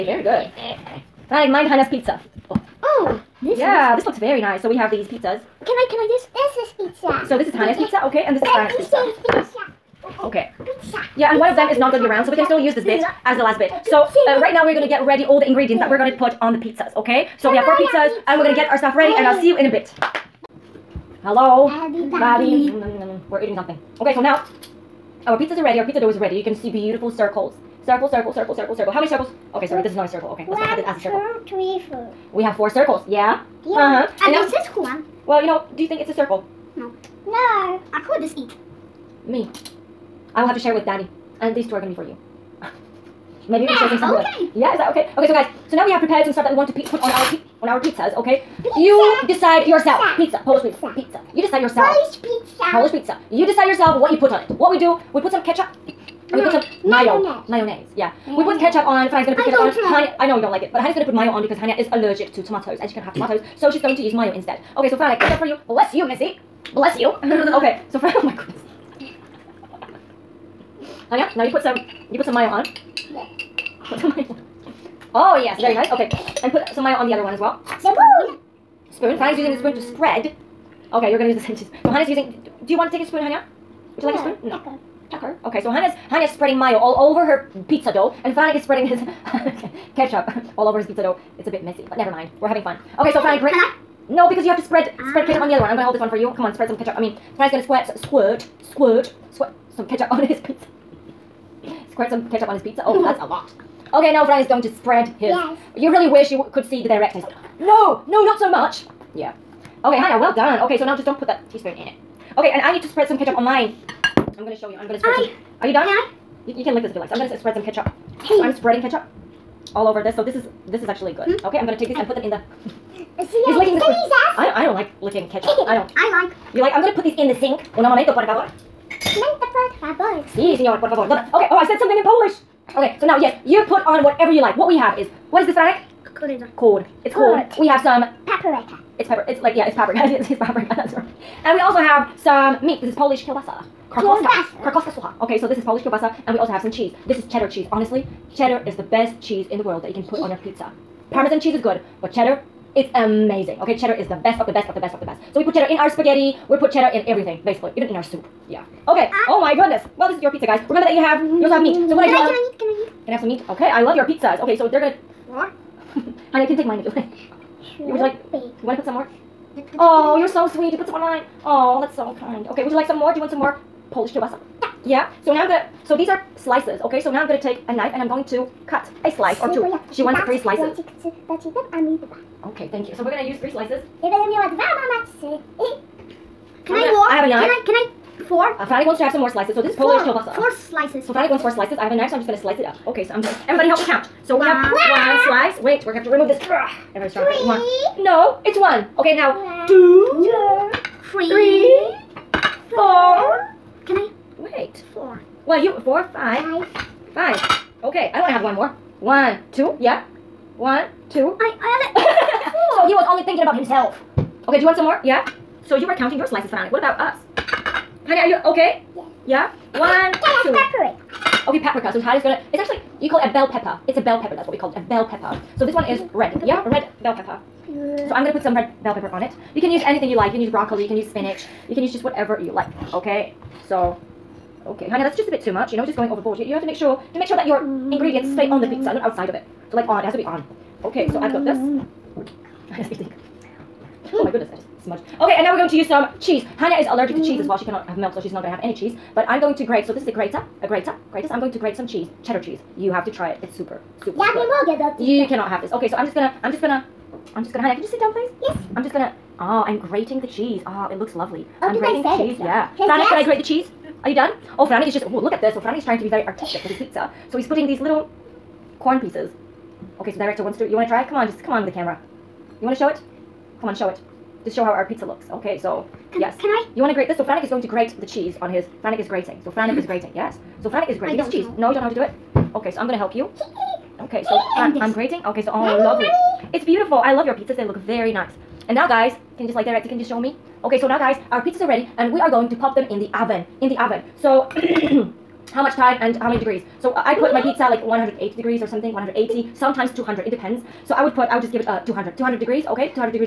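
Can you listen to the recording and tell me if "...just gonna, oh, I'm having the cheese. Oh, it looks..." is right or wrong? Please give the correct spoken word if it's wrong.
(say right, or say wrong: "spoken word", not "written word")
wrong: "grating", not "having".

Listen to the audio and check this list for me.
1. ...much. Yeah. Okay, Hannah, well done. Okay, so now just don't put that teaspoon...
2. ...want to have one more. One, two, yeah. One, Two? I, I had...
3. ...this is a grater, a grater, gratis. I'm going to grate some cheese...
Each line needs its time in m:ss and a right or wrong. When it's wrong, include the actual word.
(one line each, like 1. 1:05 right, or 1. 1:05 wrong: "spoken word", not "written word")
1. 1:48 right
2. 3:28 right
3. 4:09 right.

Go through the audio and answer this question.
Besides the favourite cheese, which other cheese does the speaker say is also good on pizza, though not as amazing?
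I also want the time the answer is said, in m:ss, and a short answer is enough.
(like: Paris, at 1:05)
Parmesan, at 2:31.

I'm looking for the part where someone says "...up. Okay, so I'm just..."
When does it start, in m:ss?
3:12.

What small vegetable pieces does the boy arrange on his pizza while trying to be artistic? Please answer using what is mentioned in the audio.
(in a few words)
Corn.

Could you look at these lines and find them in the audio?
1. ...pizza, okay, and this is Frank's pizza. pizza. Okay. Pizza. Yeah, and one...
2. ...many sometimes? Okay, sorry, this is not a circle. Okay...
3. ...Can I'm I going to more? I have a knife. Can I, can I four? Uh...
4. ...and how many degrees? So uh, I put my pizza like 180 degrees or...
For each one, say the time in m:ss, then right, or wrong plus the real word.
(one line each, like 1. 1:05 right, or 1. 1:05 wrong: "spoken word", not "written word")
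1. 0:07 right
2. 0:29 wrong: "circles", not "sometimes"
3. 3:04 right
4. 4:56 right.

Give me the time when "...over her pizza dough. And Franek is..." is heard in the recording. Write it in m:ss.
1:27.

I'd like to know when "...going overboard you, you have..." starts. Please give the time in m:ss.
3:55.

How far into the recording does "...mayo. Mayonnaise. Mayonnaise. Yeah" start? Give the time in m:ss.
0:56.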